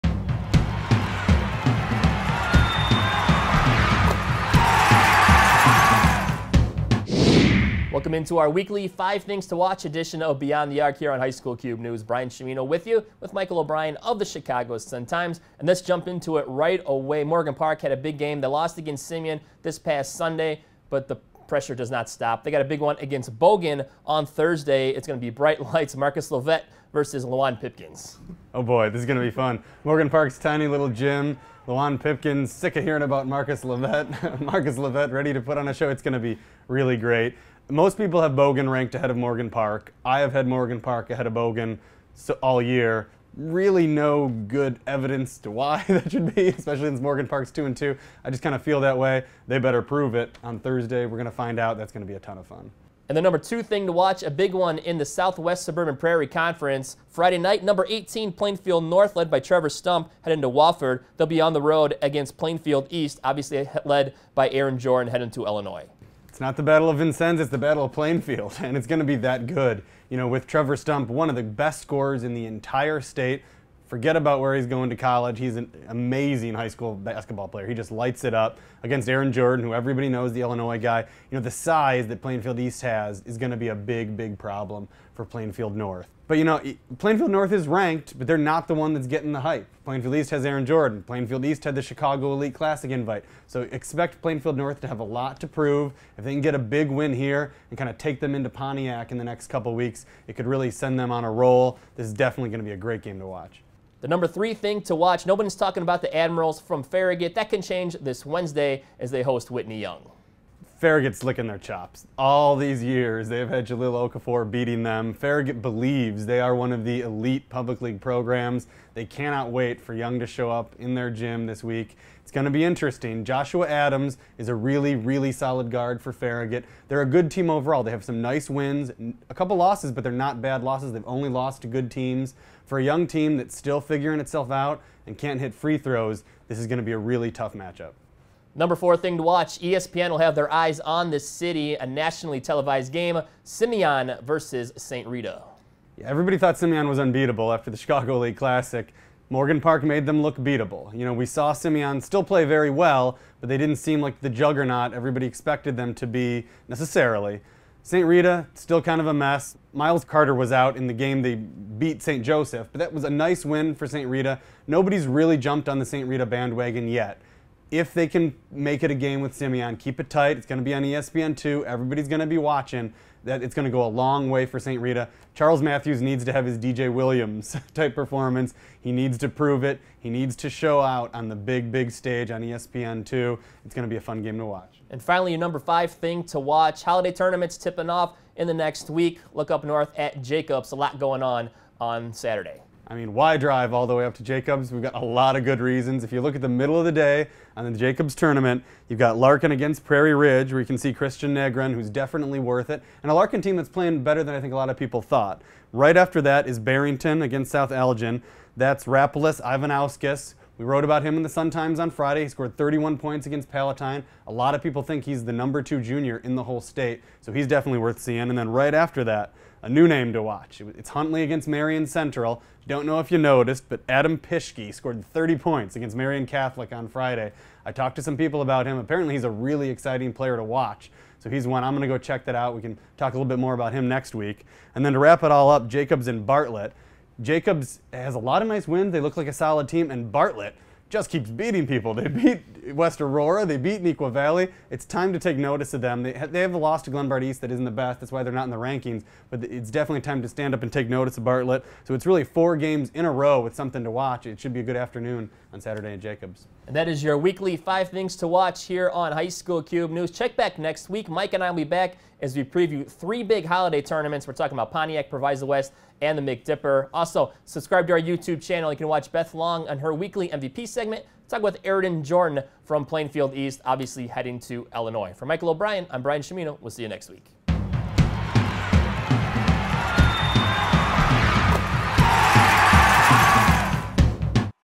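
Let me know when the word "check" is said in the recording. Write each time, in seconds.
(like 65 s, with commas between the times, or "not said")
231 s, 260 s.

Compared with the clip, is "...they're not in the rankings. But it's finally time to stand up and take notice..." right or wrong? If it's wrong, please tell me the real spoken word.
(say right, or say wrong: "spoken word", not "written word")
wrong: "definitely", not "finally".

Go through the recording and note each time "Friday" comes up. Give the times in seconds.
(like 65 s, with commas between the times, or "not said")
57 s, 211 s, 226 s.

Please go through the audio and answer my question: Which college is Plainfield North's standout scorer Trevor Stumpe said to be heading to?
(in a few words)
Wofford.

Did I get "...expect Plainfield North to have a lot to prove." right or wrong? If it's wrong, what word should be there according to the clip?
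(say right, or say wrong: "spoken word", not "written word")
right.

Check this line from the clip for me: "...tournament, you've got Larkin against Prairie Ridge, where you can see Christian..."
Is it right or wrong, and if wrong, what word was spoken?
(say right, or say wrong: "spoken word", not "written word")
right.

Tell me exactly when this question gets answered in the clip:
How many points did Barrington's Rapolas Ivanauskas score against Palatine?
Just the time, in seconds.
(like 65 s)
212 s.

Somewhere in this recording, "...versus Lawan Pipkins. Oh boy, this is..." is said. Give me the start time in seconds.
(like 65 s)
26 s.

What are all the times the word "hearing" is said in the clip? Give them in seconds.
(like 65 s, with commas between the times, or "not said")
32 s.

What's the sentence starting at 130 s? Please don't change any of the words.
They've only lost to good teams.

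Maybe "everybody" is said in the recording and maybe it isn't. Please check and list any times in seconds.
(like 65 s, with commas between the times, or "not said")
79 s, 146 s, 154 s, 171 s.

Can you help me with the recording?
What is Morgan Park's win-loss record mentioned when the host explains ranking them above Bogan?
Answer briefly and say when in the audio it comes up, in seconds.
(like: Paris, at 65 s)
2-2, at 47 s.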